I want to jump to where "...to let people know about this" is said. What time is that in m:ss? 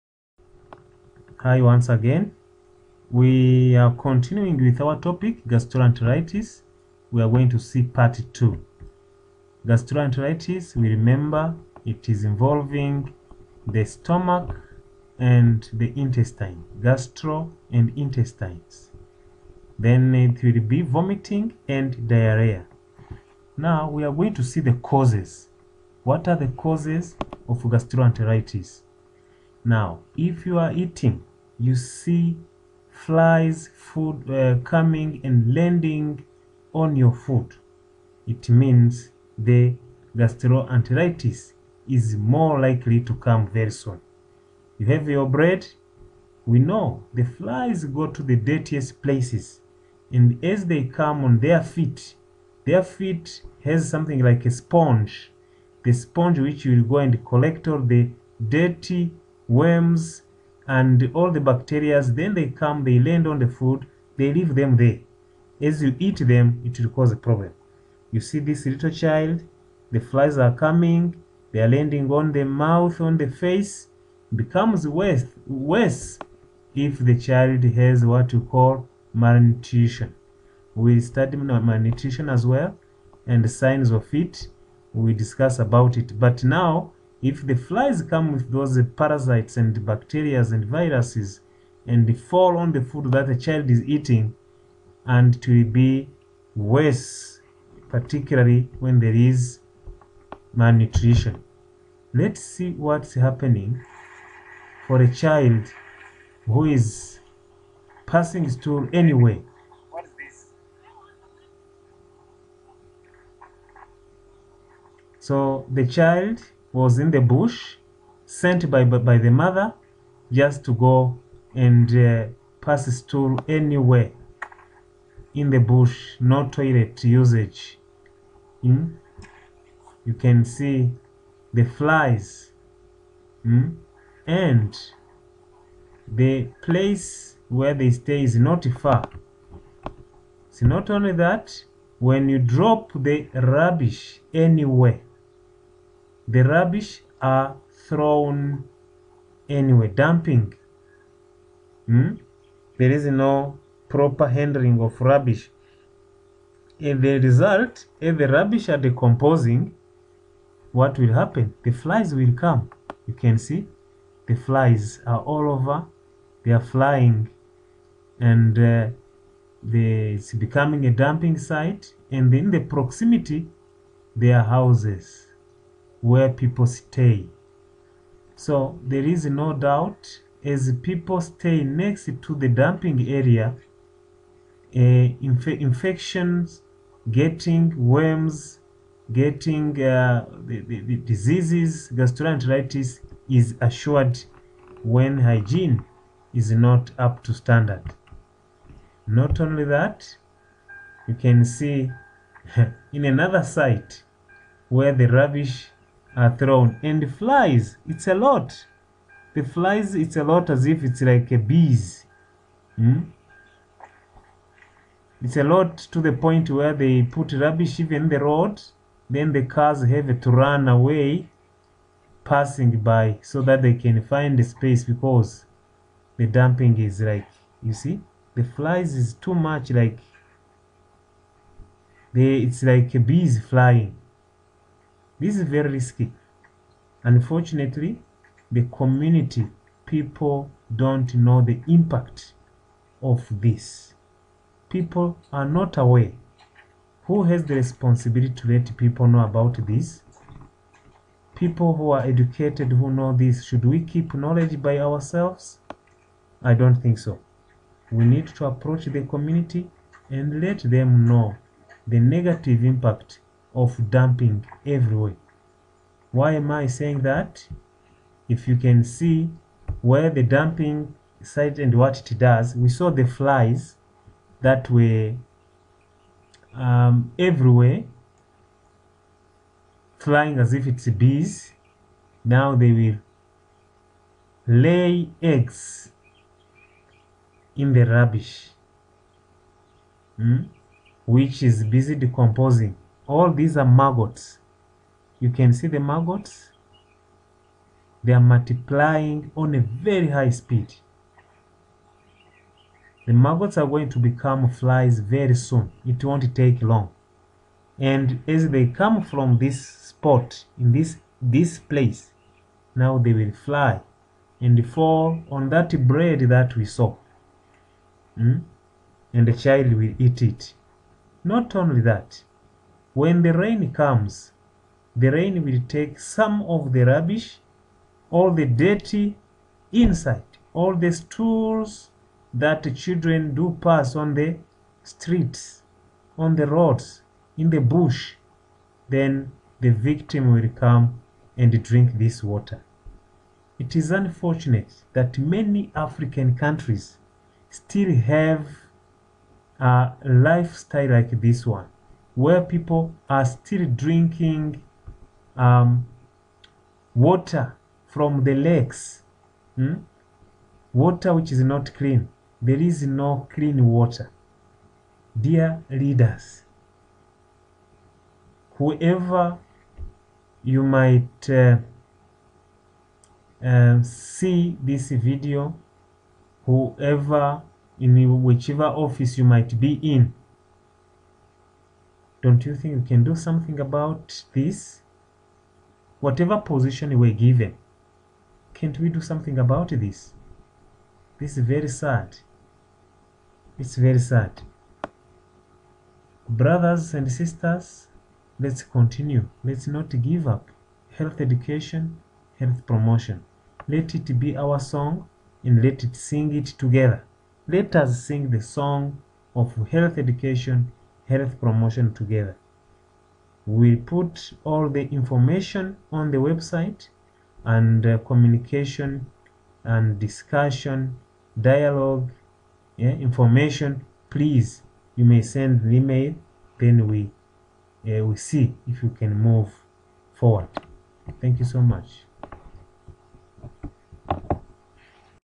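4:08.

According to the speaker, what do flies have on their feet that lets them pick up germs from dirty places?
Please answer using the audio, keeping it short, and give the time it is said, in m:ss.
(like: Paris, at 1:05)
Something like a sponge, at 0:53.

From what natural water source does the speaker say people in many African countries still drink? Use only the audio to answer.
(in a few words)
Lakes.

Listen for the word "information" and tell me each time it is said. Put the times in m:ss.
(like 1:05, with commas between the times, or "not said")
6:54, 7:03.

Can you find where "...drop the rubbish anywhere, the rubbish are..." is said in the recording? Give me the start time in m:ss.
2:22.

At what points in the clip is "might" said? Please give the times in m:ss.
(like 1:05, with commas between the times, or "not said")
6:10, 6:19.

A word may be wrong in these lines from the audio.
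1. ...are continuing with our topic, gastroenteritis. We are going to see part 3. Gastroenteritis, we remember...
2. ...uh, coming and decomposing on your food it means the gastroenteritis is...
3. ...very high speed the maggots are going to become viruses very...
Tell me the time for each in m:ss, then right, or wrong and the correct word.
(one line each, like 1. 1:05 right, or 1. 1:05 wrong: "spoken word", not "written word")
1. 0:03 wrong: "2", not "3"
2. 0:34 wrong: "landing", not "decomposing"
3. 4:59 wrong: "flies", not "viruses".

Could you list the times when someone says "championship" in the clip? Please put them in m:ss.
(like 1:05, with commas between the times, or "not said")
not said.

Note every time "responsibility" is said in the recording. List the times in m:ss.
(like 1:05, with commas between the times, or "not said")
4:07.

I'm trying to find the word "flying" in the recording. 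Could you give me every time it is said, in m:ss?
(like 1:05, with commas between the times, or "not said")
2:46, 3:53, 4:39.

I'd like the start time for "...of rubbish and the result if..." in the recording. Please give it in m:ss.
2:34.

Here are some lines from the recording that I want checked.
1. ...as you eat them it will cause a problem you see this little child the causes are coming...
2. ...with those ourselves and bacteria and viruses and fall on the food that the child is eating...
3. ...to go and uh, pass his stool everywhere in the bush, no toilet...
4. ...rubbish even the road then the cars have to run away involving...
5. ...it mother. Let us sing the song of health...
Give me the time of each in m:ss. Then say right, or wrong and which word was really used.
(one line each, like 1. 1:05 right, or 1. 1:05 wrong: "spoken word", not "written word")
1. 1:05 wrong: "flies", not "causes"
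2. 1:28 wrong: "parasites", not "ourselves"
3. 2:00 wrong: "anywhere", not "everywhere"
4. 3:37 wrong: "passing", not "involving"
5. 6:46 wrong: "together", not "mother".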